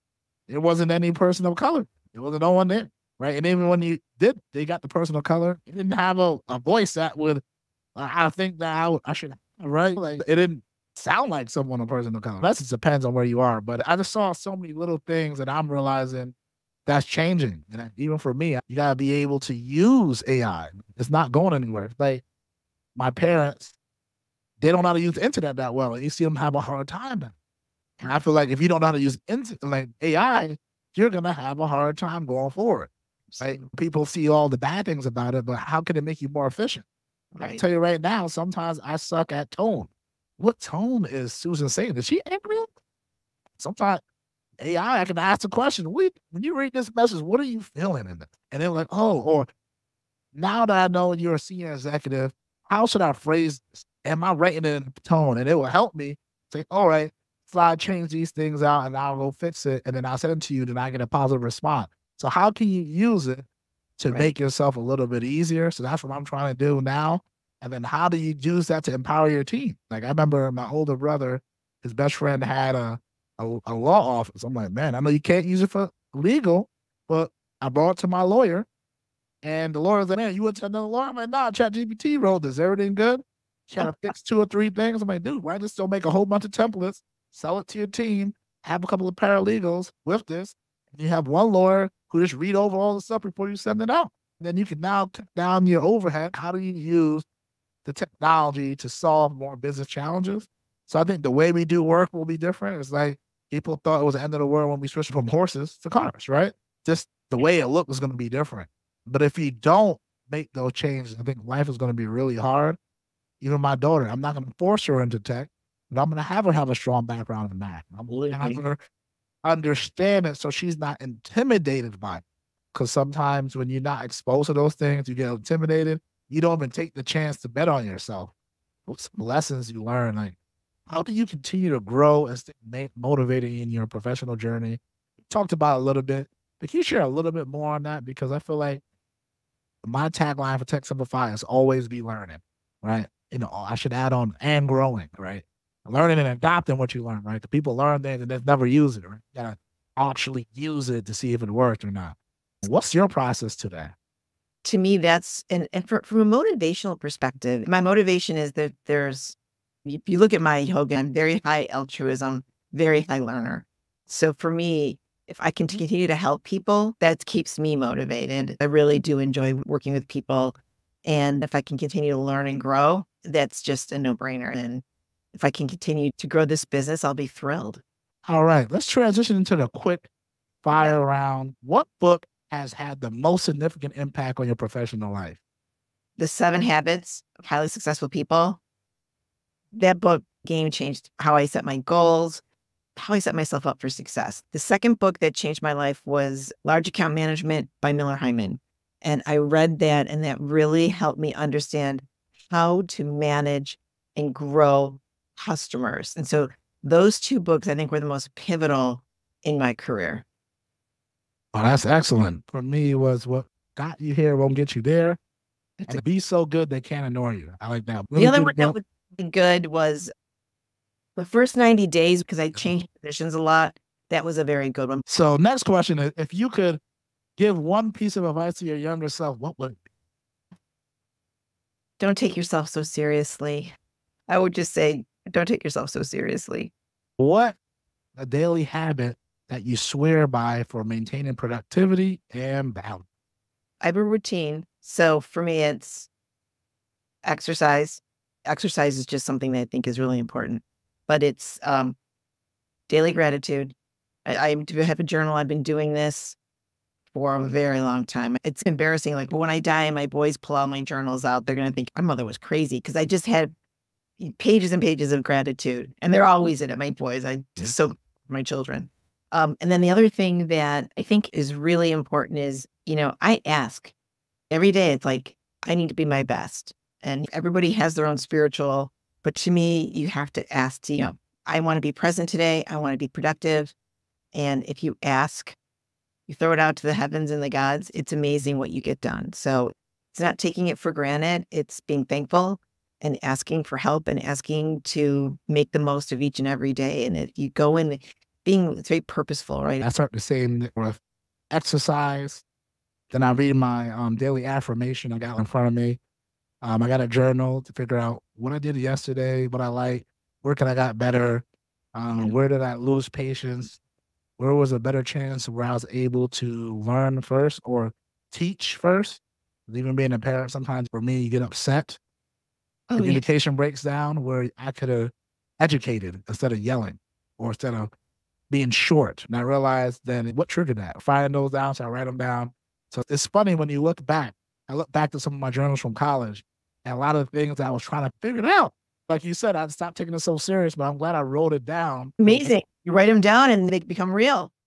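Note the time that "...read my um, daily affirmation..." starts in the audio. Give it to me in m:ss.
5:03.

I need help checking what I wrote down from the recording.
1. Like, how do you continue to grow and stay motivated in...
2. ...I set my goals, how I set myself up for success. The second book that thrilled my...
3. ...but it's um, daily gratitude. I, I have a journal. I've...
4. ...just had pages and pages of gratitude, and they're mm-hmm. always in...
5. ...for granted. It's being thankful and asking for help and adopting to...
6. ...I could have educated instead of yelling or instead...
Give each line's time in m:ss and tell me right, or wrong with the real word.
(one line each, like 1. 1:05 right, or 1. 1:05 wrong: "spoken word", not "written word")
1. 2:10 right
2. 3:11 wrong: "changed", not "thrilled"
3. 4:11 right
4. 4:23 right
5. 4:50 wrong: "asking", not "adopting"
6. 5:24 right.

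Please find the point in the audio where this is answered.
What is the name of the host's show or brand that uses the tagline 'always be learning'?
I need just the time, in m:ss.
2:20.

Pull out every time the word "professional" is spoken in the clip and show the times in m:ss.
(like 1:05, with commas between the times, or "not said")
2:13, 3:04.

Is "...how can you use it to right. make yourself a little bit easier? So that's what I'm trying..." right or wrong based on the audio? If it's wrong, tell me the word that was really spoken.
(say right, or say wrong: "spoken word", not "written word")
right.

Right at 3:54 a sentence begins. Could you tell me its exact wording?
I would just say don't take yourself so seriously.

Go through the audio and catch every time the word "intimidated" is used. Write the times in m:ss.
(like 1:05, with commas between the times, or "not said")
2:00, 2:05.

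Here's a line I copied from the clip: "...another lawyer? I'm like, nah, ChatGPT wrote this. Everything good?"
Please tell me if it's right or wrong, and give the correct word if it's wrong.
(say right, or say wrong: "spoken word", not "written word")
right.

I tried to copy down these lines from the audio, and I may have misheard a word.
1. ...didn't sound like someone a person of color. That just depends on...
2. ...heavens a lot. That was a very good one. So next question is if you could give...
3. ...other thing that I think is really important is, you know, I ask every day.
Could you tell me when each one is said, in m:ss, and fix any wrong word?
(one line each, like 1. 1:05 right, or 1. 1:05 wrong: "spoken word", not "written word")
1. 0:10 right
2. 3:42 wrong: "positions", not "heavens"
3. 4:29 right.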